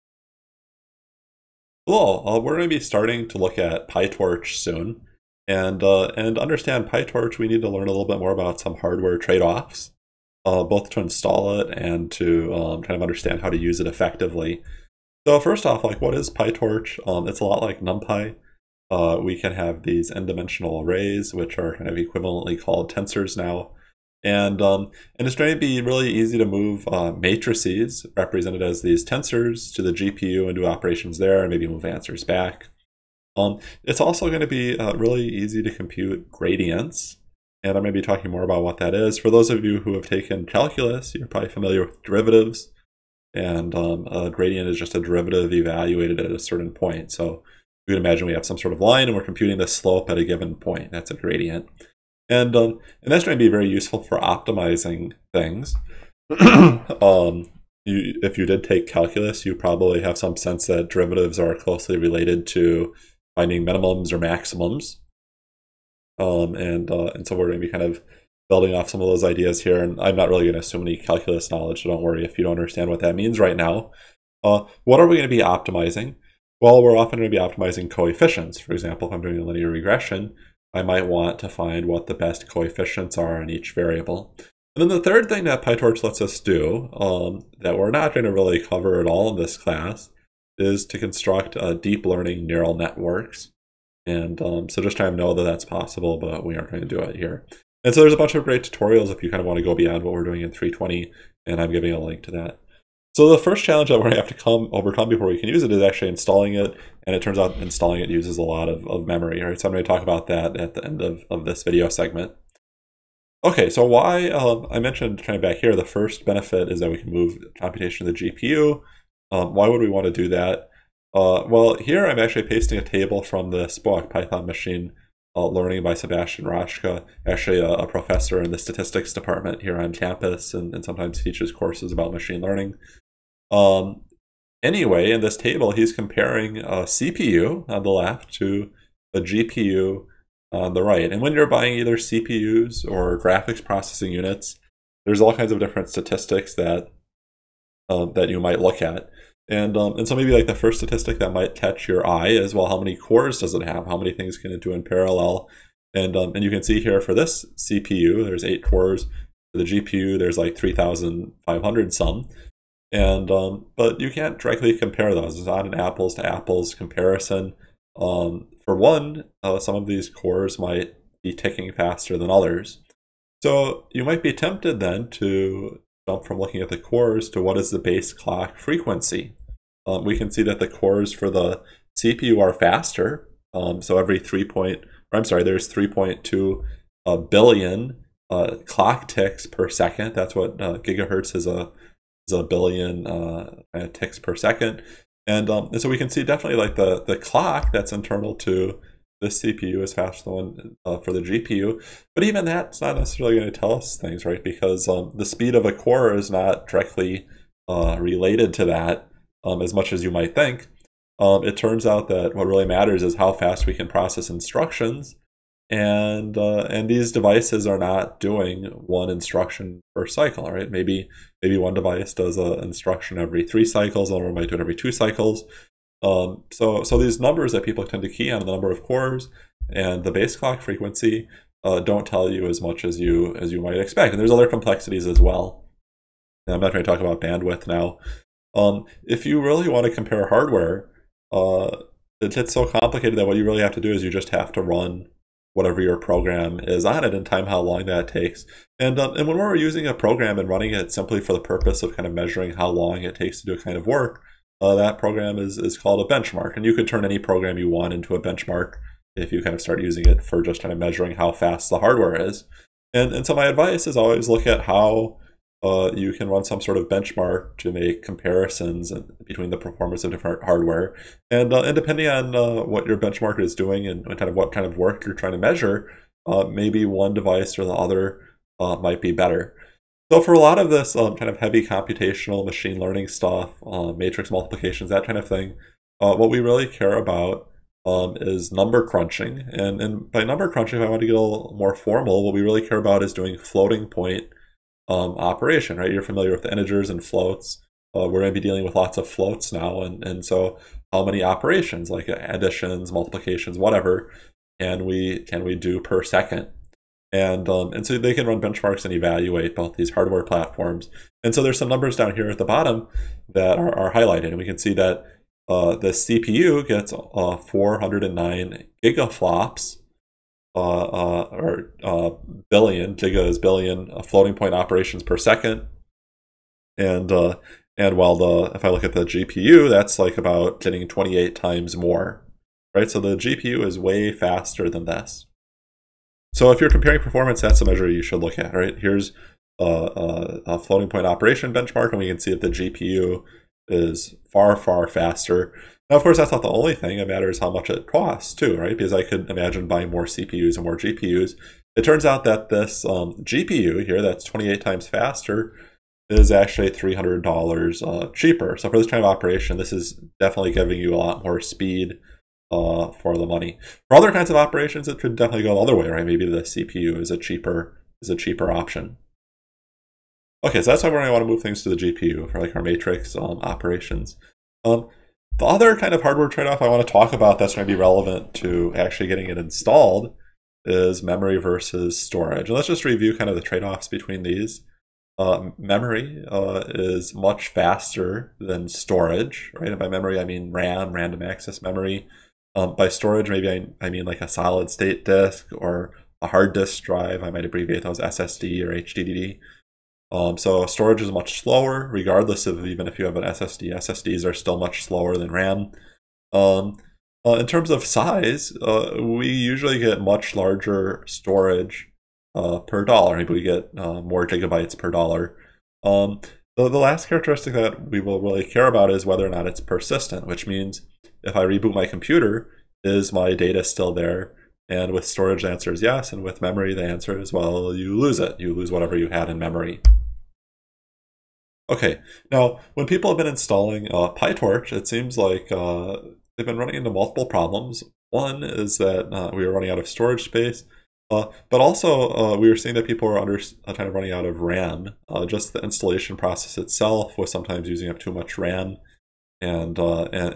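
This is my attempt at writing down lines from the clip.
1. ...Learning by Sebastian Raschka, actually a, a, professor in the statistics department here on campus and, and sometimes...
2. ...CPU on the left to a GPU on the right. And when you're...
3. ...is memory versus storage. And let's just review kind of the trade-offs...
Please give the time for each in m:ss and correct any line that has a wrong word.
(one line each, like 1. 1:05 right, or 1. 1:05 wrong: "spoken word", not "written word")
1. 2:05 right
2. 2:16 right
3. 6:20 right.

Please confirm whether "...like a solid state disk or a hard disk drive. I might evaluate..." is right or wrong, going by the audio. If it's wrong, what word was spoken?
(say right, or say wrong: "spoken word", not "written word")
wrong: "abbreviate", not "evaluate".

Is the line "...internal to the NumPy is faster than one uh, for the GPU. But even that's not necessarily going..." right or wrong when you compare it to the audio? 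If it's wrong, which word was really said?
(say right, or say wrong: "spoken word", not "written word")
wrong: "CPU", not "NumPy".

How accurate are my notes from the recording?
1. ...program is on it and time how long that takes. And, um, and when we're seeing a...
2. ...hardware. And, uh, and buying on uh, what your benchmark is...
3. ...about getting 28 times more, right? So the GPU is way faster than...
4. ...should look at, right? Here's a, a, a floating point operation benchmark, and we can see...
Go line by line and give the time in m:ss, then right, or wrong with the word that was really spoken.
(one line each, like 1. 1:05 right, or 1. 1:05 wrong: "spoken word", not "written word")
1. 4:05 wrong: "using", not "seeing"
2. 4:30 wrong: "depending", not "buying"
3. 5:30 right
4. 5:38 right.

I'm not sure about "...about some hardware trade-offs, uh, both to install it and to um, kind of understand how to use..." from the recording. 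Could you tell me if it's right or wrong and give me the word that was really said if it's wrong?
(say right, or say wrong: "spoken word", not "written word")
right.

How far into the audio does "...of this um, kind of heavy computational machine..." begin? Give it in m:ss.
4:40.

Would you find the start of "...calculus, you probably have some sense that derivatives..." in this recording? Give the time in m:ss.
0:58.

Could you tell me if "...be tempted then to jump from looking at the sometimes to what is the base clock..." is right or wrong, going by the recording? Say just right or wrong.
wrong.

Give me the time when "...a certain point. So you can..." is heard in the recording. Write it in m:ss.
0:46.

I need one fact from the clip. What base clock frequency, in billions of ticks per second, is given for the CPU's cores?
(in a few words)
3.2.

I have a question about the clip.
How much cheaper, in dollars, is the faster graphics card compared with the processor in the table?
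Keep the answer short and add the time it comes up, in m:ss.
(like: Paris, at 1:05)
$300, at 5:56.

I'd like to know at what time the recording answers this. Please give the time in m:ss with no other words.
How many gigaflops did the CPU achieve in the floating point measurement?
5:17.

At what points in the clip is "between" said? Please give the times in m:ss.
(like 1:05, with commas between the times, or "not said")
4:29, 6:23.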